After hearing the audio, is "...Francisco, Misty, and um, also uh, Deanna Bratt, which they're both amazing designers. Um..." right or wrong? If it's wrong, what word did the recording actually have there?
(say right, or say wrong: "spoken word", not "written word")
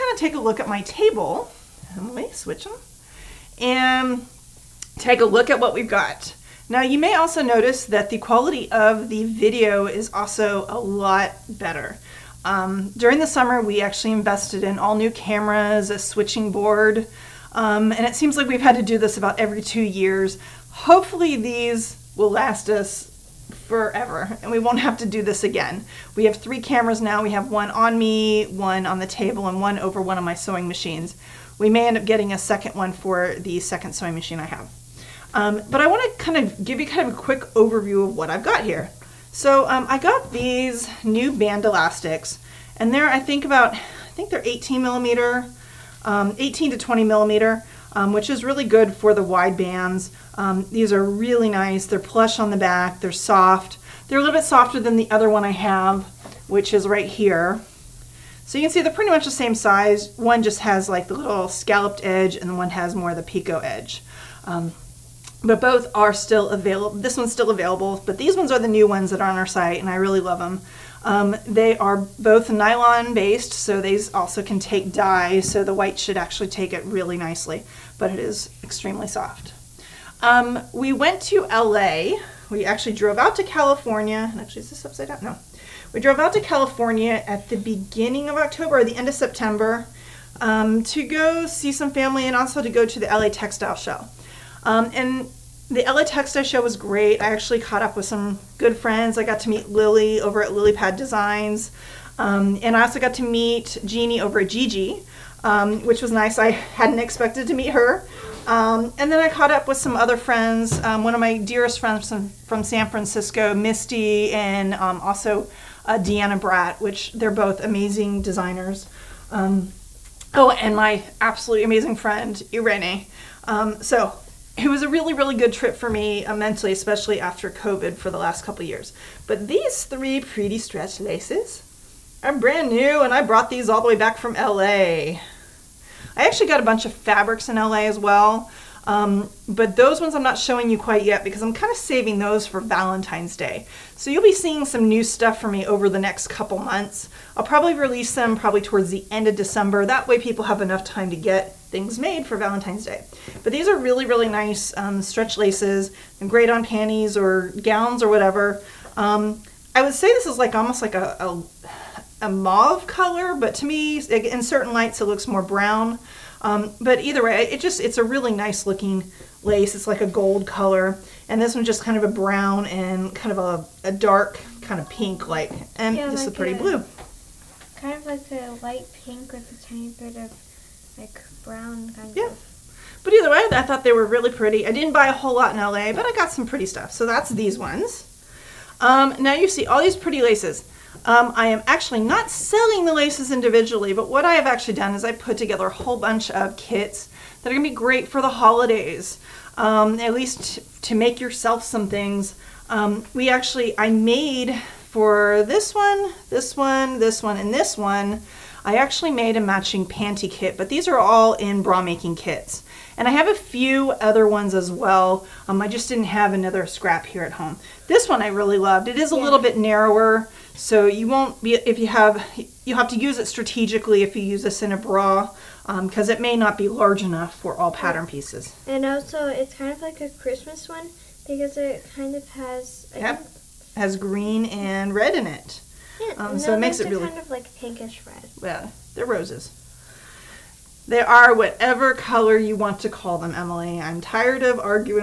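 right.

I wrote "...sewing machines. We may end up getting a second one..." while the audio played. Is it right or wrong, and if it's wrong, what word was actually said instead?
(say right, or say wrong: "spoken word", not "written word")
right.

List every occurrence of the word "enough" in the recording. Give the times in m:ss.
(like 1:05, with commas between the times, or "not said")
2:30, 3:47.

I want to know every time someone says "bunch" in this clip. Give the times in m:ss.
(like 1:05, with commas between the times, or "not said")
2:16, 3:15.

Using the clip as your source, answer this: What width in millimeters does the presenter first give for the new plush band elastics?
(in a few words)
18 millimeter.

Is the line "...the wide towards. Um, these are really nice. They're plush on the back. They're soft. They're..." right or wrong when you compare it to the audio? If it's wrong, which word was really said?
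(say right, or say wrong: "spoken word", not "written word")
wrong: "bands", not "towards".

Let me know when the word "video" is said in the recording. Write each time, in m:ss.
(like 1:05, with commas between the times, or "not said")
0:09.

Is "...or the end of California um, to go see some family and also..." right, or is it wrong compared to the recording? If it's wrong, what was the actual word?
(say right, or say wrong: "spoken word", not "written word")
wrong: "September", not "California".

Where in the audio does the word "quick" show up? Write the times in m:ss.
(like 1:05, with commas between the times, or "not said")
0:37.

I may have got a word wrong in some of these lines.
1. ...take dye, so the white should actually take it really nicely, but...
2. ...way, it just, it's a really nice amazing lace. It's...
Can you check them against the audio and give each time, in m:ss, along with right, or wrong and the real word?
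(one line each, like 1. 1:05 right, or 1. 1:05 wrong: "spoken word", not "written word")
1. 1:14 right
2. 2:47 wrong: "looking", not "amazing".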